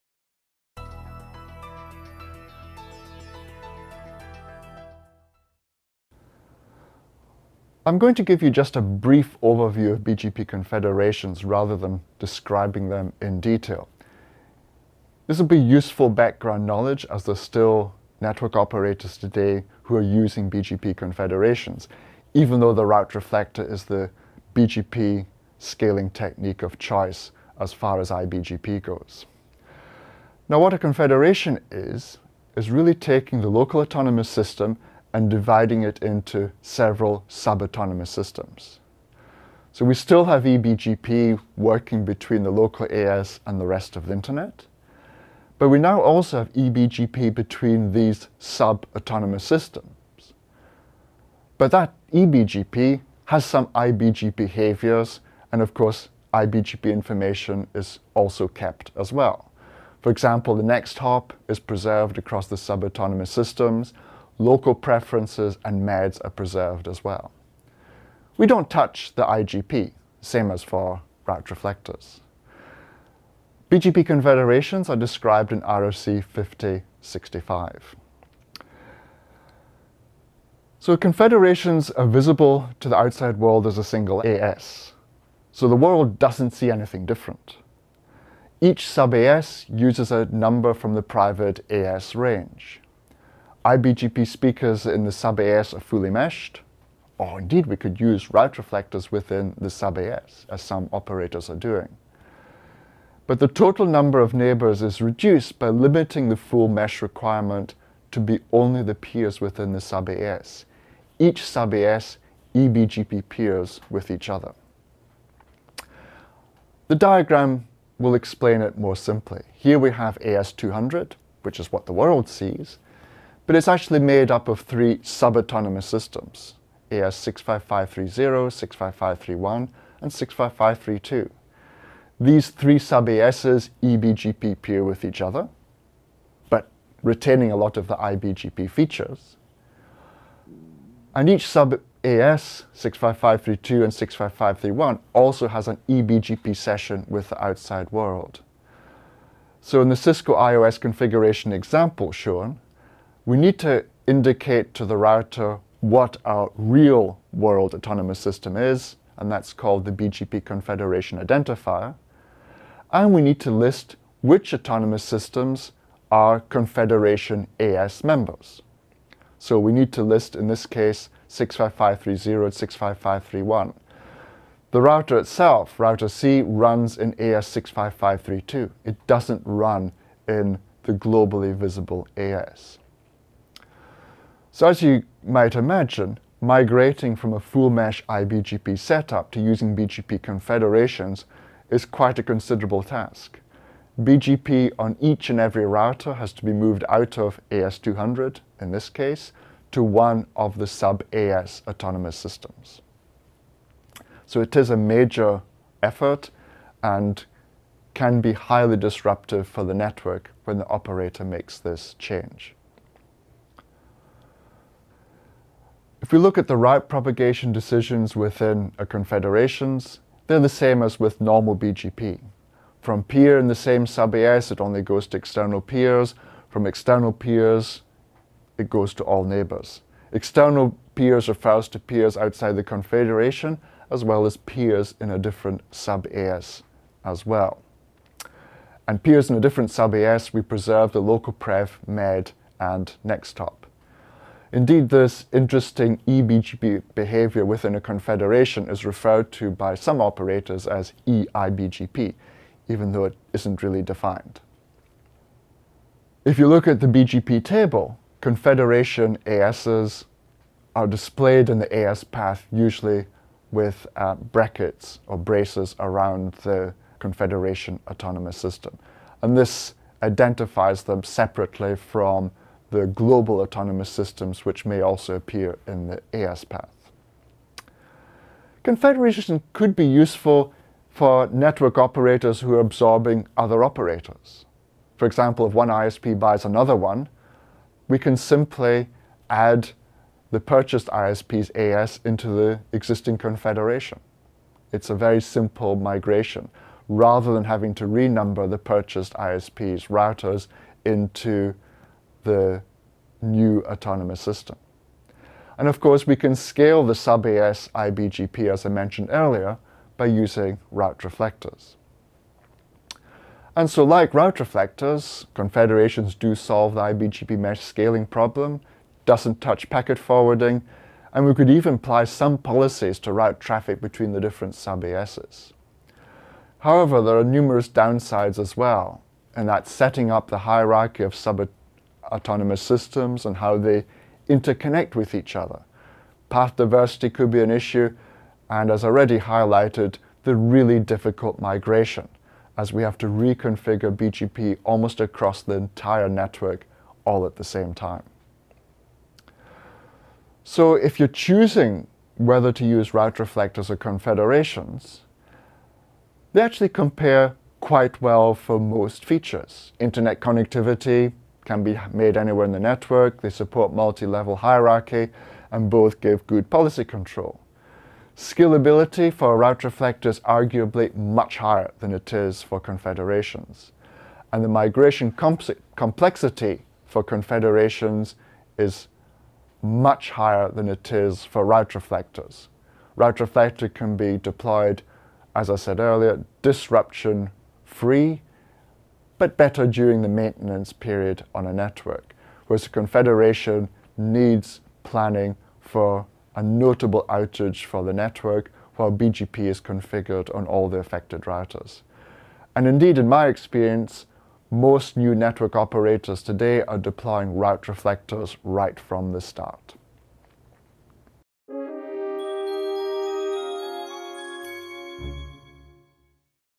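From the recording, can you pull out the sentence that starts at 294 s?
It's a very simple migration, rather than having to renumber the purchased ISP's routers into the new autonomous system.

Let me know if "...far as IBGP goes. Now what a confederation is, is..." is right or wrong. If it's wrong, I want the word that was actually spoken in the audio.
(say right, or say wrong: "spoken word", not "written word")
right.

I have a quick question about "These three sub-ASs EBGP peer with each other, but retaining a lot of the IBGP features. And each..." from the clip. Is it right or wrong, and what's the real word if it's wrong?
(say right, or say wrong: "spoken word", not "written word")
right.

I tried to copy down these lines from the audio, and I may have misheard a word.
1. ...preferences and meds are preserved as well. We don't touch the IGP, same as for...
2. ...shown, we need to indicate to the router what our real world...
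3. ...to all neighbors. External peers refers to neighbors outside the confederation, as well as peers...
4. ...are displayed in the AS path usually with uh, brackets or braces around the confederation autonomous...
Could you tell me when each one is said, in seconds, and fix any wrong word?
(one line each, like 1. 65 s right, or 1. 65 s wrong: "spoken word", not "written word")
1. 64 s right
2. 152 s right
3. 228 s wrong: "peers", not "neighbors"
4. 260 s right.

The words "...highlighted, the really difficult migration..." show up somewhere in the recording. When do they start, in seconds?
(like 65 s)
339 s.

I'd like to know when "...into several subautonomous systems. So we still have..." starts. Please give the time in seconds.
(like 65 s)
36 s.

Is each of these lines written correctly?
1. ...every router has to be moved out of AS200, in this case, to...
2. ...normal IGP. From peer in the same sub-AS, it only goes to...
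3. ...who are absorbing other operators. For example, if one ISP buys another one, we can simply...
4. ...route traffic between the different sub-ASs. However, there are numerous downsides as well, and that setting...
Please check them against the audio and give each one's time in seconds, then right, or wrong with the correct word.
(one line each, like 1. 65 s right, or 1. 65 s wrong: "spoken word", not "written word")
1. 195 s right
2. 221 s wrong: "BGP", not "IGP"
3. 282 s right
4. 323 s right.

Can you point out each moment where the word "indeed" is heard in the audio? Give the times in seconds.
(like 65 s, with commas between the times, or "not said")
97 s, 244 s, 402 s.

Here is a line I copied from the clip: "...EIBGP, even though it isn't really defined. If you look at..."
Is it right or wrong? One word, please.
right.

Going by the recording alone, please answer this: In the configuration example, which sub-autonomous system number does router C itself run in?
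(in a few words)
AS65532.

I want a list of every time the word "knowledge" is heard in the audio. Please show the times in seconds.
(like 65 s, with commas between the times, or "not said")
16 s.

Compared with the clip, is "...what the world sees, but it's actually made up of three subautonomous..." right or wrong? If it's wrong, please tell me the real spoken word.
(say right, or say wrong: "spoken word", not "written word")
right.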